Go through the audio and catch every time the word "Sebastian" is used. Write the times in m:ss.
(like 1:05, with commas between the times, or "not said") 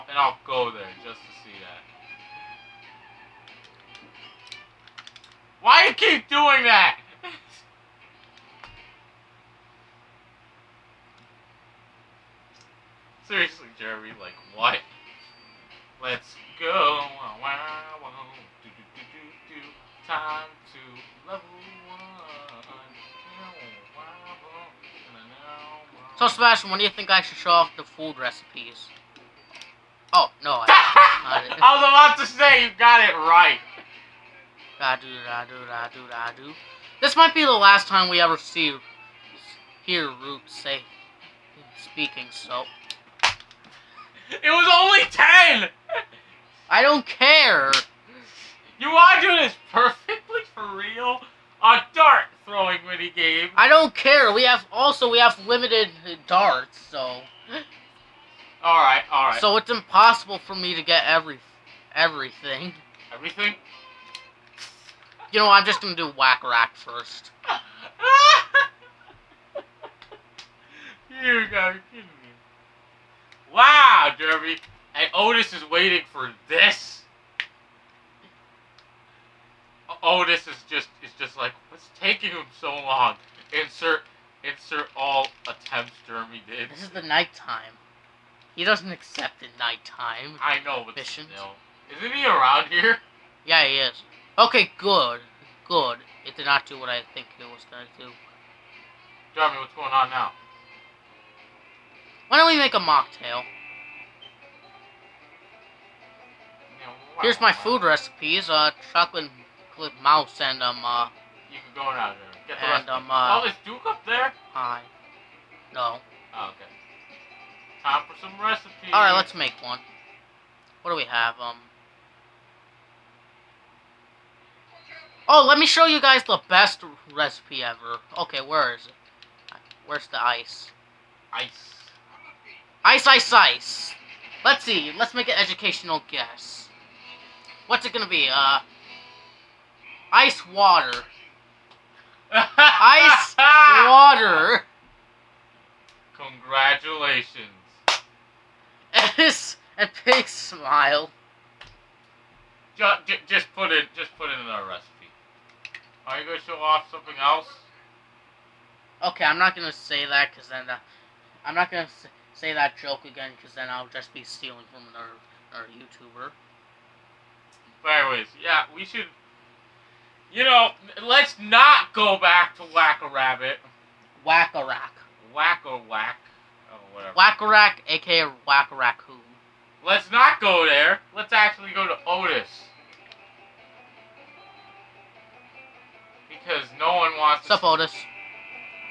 0:26.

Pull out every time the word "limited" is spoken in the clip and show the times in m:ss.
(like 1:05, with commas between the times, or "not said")
0:55.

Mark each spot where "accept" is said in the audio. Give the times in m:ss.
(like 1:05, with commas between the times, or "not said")
1:28.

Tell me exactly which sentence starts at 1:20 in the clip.
Otis is just just like, what's taking him so long?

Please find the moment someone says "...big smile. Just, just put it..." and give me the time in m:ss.
2:30.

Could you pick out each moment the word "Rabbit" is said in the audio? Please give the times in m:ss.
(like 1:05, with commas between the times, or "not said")
2:53.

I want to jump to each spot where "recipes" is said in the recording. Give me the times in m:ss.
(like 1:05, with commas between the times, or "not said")
0:28, 1:47, 1:58, 2:07, 2:34.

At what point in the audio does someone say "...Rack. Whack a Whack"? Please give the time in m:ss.
2:54.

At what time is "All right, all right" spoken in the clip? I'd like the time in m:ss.
0:58.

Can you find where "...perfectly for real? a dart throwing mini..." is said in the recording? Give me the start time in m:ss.
0:49.